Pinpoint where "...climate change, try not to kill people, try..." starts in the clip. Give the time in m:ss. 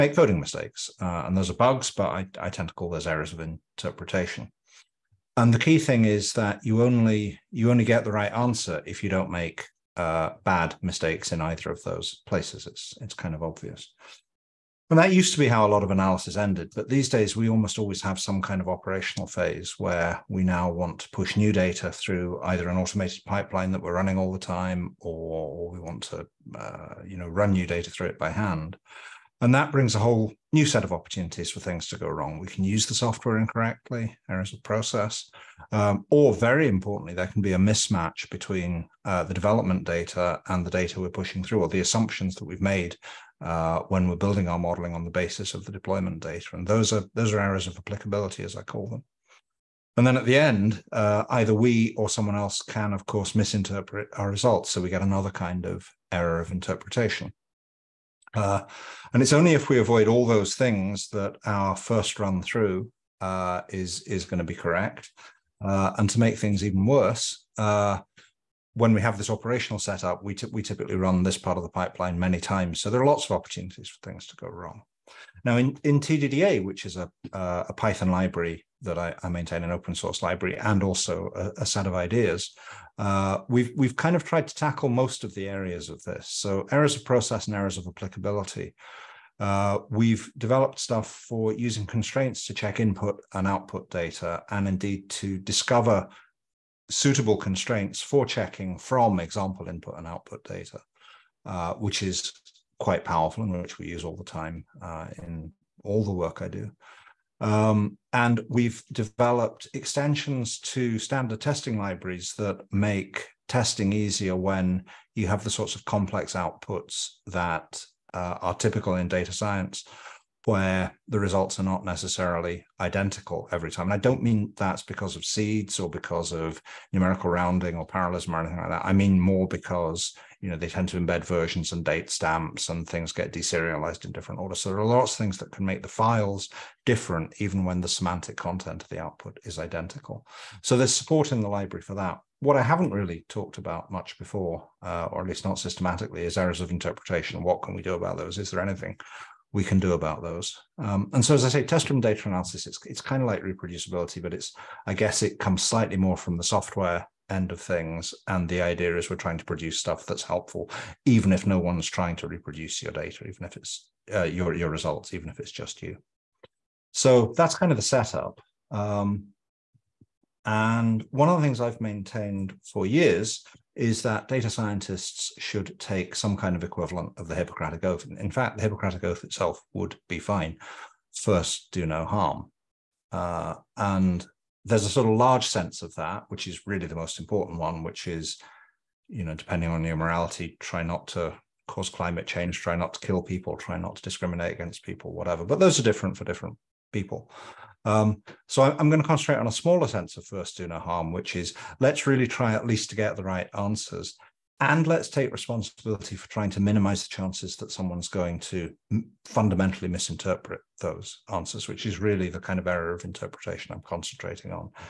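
3:11.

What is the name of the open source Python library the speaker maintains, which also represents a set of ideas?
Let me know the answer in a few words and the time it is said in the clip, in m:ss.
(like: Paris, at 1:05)
TDDA, at 1:15.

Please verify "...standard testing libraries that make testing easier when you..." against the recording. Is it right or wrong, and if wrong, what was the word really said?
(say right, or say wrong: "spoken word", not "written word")
right.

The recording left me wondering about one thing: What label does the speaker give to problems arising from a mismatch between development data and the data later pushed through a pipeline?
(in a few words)
Areas of applicability.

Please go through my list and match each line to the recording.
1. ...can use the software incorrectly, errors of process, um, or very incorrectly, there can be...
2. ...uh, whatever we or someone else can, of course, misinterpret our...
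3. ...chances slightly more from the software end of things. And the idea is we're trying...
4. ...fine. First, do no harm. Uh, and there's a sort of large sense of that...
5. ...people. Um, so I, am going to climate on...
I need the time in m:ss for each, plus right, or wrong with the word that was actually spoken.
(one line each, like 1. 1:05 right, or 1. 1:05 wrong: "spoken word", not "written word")
1. 0:32 wrong: "importantly", not "incorrectly"
2. 0:50 wrong: "either", not "whatever"
3. 2:35 wrong: "comes", not "chances"
4. 3:00 right
5. 3:16 wrong: "concentrate", not "climate".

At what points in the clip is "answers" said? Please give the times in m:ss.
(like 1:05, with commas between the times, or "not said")
0:08, 3:23, 3:31.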